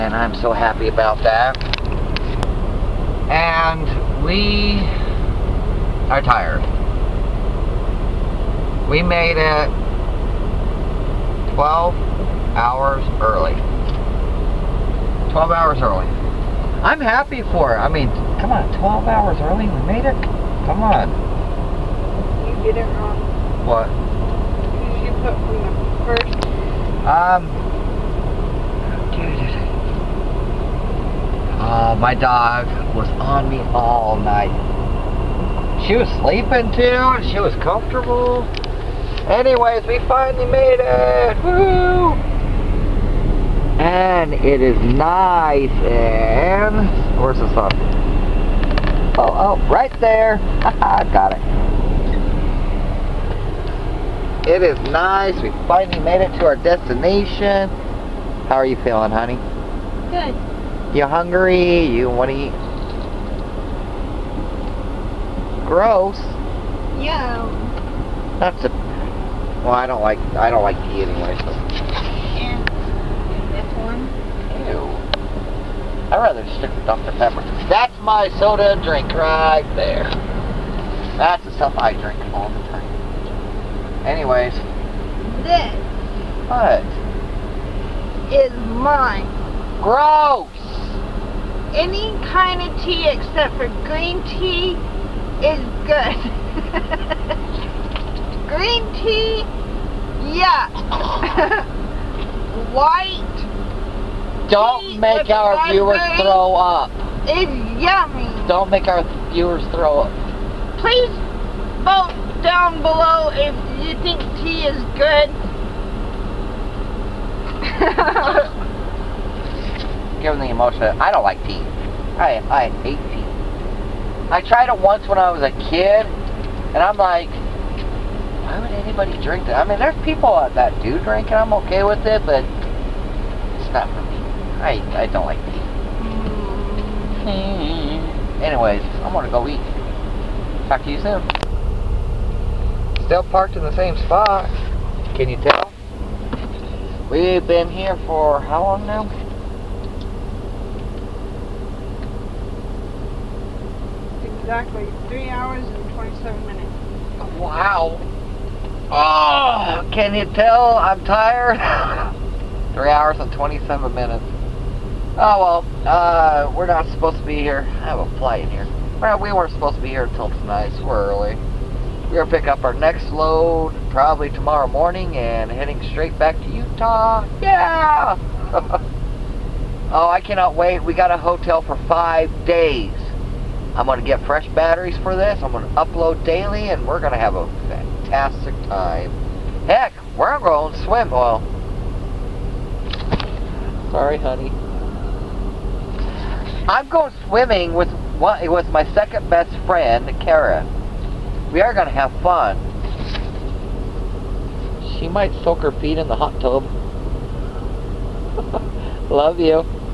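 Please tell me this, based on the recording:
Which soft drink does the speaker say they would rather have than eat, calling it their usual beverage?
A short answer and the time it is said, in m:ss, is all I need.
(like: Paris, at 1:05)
Dr. Pepper, at 1:16.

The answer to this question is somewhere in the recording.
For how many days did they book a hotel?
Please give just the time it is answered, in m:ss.
3:01.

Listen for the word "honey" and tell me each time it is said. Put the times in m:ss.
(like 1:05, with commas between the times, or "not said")
0:59, 3:14.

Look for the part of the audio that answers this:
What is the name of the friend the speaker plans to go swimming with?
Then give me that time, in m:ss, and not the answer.
3:20.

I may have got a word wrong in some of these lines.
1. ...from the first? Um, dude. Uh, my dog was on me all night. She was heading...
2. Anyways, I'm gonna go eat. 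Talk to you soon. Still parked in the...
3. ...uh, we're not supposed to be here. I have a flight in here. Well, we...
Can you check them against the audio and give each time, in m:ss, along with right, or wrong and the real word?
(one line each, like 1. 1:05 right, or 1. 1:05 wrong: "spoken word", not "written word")
1. 0:25 wrong: "sleeping", not "heading"
2. 2:18 right
3. 2:45 right.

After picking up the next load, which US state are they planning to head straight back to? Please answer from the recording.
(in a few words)
Utah.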